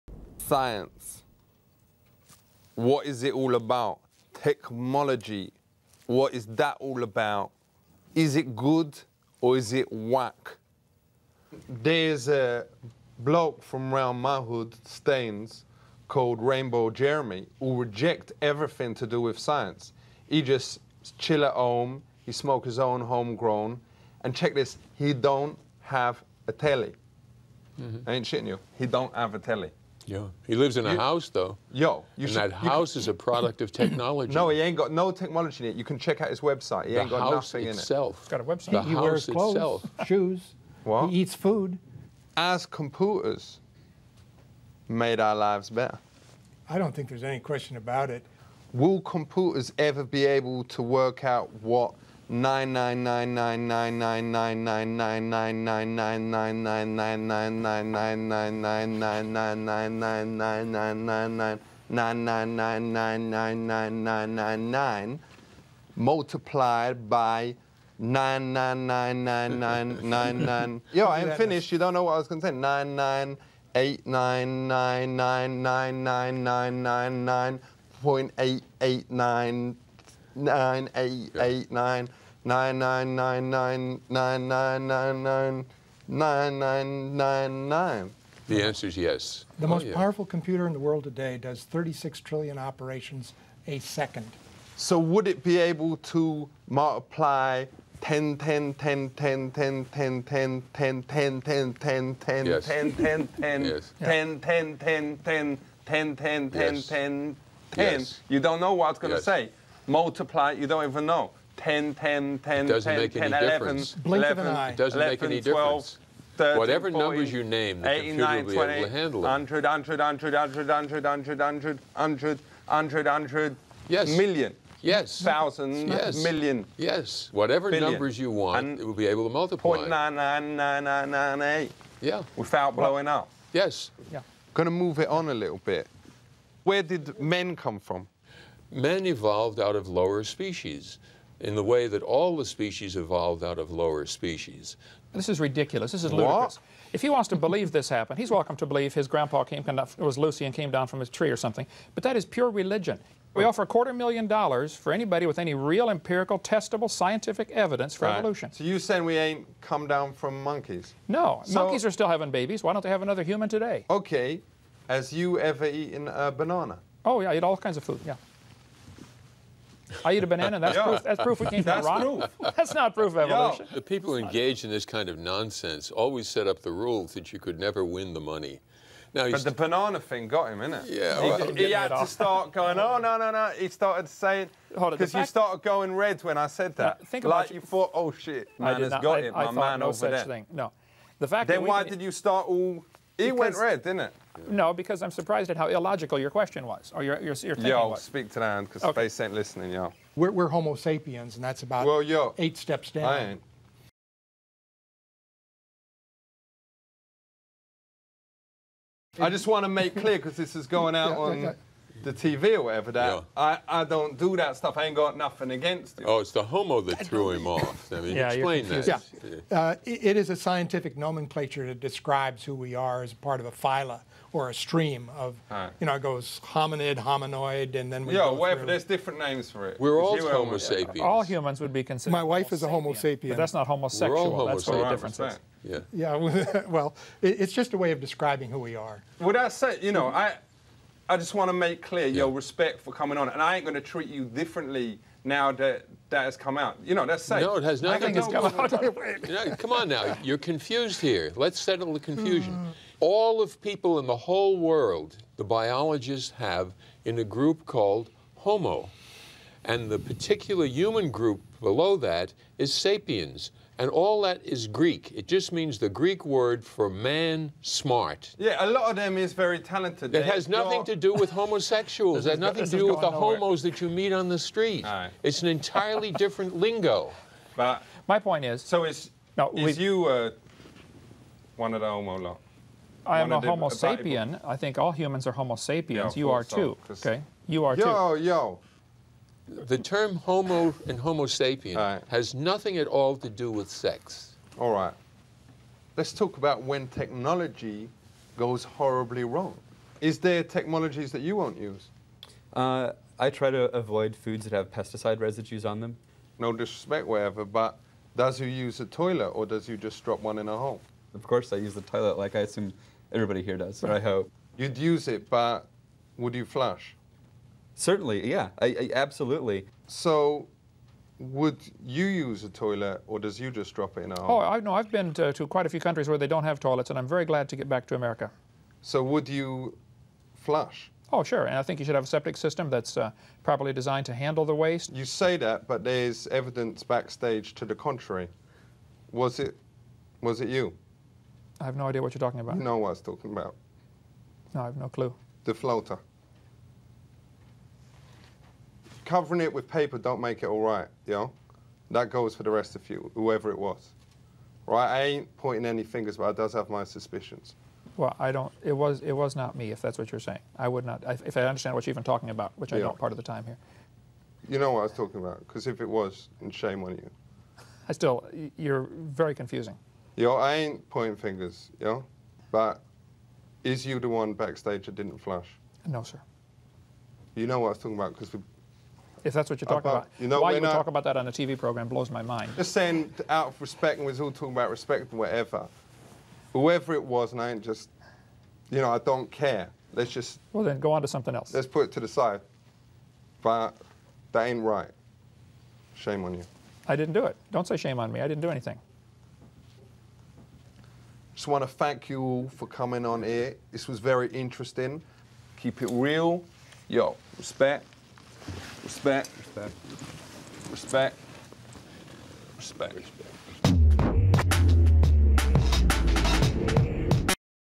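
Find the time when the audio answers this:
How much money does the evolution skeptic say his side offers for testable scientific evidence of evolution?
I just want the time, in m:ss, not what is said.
2:33.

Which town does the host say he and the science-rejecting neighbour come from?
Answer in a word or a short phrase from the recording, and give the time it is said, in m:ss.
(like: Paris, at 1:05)
Staines, at 0:14.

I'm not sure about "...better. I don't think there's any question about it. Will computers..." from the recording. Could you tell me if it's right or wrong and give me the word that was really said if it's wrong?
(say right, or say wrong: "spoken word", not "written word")
right.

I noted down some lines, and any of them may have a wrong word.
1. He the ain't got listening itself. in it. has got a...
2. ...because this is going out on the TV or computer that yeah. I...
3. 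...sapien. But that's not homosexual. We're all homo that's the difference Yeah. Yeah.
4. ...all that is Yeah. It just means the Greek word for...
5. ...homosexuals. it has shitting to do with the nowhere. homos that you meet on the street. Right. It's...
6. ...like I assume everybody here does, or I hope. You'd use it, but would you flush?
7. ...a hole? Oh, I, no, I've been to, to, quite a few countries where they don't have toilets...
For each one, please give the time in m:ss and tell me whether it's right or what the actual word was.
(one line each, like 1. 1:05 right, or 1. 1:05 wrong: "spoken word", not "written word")
1. 0:36 wrong: "nothing", not "listening"
2. 3:30 wrong: "whatever", not "computer"
3. 3:52 right
4. 4:23 wrong: "Greek", not "Yeah"
5. 4:31 wrong: "nothing", not "shitting"
6. 5:12 right
7. 5:24 right.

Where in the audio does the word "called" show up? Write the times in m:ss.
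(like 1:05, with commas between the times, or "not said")
0:16, 4:17.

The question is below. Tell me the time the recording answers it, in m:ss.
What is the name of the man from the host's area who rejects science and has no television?
0:16.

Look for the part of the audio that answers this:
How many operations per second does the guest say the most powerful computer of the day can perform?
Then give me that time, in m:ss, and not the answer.
1:31.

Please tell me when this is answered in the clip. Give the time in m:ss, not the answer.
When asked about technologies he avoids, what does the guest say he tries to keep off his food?
5:04.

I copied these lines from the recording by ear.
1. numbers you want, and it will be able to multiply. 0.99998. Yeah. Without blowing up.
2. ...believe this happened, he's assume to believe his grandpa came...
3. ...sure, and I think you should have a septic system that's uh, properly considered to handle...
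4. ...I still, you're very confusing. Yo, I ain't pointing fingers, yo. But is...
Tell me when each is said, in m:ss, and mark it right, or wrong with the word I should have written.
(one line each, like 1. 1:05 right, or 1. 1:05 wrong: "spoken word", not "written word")
1. 2:07 right
2. 2:27 wrong: "welcome", not "assume"
3. 5:31 wrong: "designed", not "considered"
4. 6:07 right.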